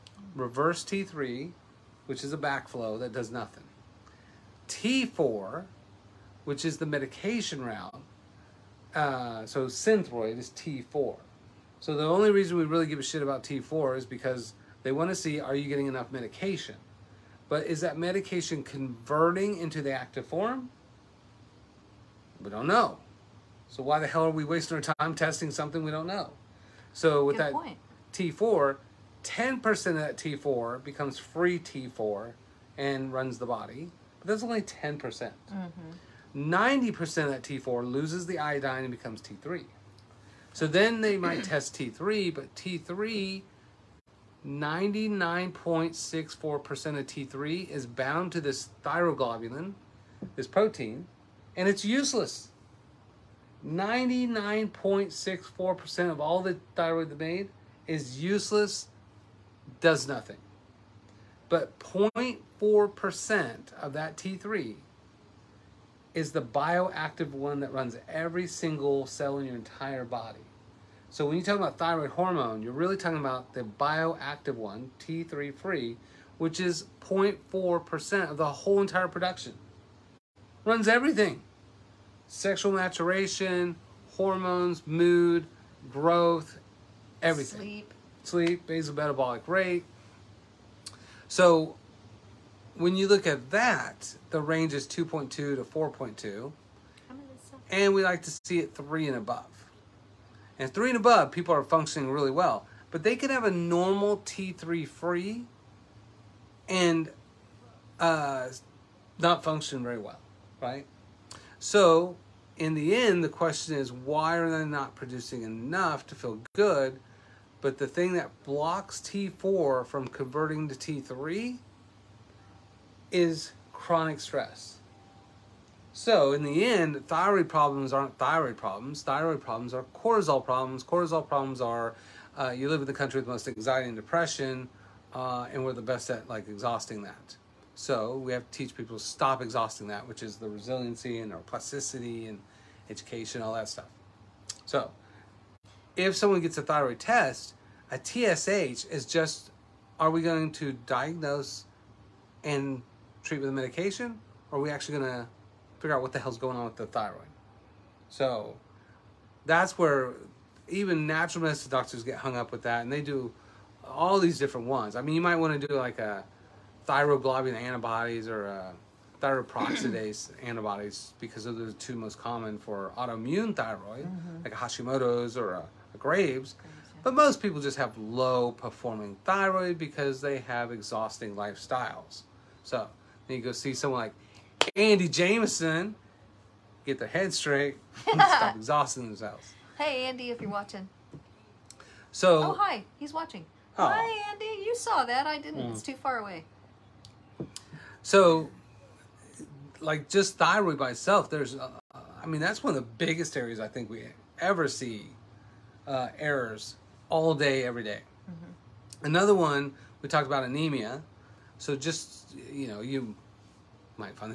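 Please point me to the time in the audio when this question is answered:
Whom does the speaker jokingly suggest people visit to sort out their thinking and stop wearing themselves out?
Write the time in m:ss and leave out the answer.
3:04.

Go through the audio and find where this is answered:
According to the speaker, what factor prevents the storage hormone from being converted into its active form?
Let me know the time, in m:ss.
2:03.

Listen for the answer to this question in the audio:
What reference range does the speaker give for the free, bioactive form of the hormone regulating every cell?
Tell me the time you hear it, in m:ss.
1:34.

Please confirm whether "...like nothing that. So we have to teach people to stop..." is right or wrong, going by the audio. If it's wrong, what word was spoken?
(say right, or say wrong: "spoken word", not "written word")
wrong: "exhausting", not "nothing".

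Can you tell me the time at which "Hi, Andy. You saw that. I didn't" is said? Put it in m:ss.
3:13.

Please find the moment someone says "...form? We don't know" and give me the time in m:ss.
0:20.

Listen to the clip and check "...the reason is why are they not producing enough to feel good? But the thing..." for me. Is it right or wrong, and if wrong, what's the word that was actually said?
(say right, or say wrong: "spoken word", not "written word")
wrong: "question", not "reason".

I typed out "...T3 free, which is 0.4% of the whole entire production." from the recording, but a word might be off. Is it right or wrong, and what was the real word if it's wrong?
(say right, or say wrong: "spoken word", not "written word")
right.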